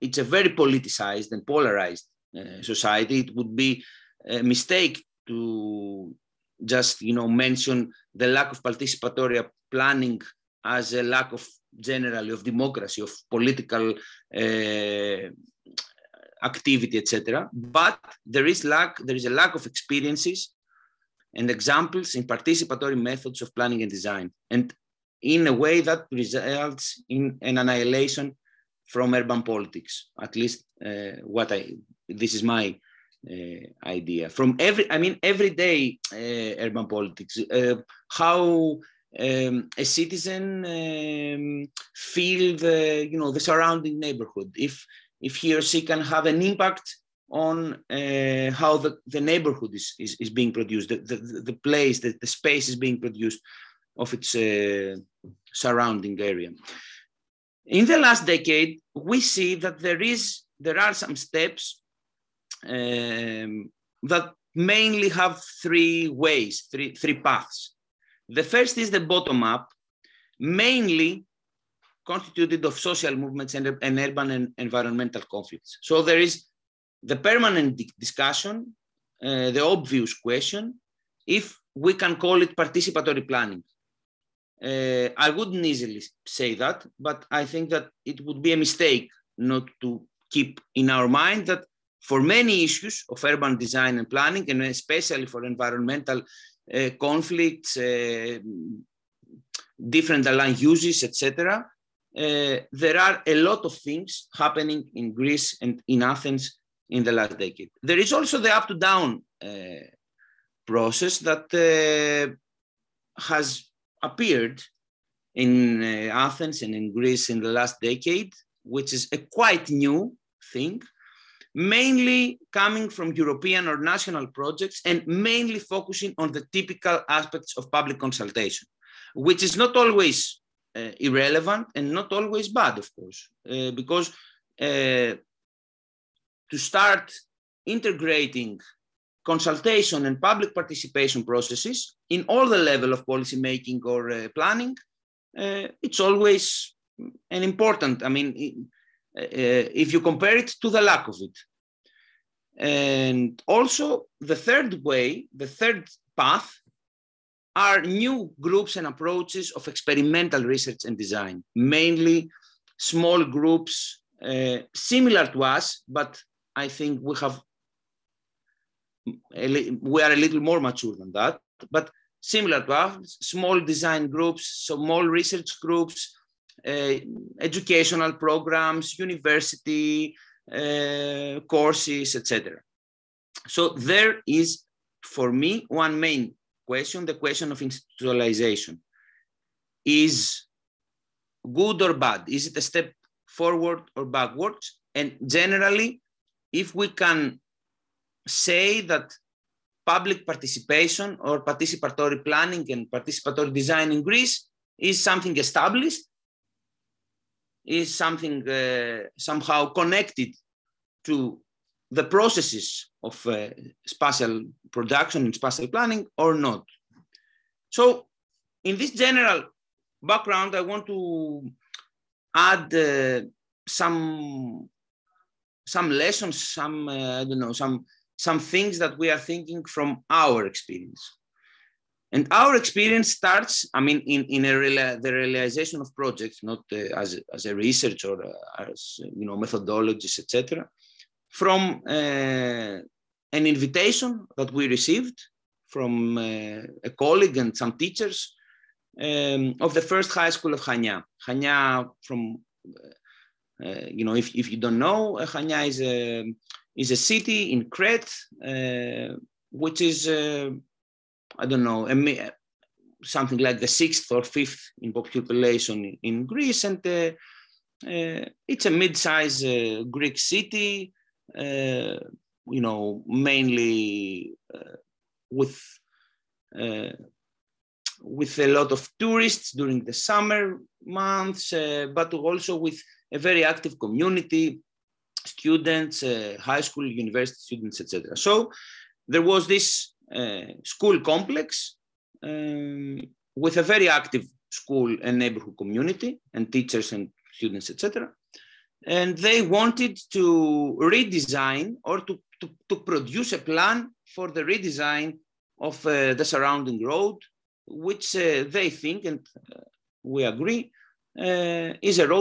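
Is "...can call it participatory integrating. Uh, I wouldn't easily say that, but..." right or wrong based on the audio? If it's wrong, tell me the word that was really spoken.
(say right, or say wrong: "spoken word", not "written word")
wrong: "planning", not "integrating".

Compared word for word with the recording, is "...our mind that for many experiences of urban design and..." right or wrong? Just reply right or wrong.
wrong.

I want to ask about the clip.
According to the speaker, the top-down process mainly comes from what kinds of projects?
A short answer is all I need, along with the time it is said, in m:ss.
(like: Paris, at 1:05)
European or national projects, at 2:03.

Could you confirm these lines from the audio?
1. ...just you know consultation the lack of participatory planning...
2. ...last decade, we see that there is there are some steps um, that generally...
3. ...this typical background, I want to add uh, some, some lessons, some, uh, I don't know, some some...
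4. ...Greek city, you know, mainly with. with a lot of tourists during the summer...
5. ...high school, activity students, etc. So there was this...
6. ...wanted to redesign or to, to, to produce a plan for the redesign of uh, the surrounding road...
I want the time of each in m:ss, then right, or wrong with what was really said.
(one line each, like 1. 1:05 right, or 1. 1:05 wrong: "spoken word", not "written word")
1. 0:06 wrong: "mention", not "consultation"
2. 0:57 wrong: "mainly", not "generally"
3. 3:38 wrong: "general", not "typical"
4. 4:29 right
5. 4:46 wrong: "university", not "activity"
6. 4:59 right.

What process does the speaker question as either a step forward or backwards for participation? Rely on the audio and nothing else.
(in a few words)
institutionalization.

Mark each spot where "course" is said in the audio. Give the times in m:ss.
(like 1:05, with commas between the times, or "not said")
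2:12, 3:01.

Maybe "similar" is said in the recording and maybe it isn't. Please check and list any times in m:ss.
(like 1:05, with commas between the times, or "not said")
2:44, 2:52.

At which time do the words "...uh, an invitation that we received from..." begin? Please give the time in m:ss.
4:01.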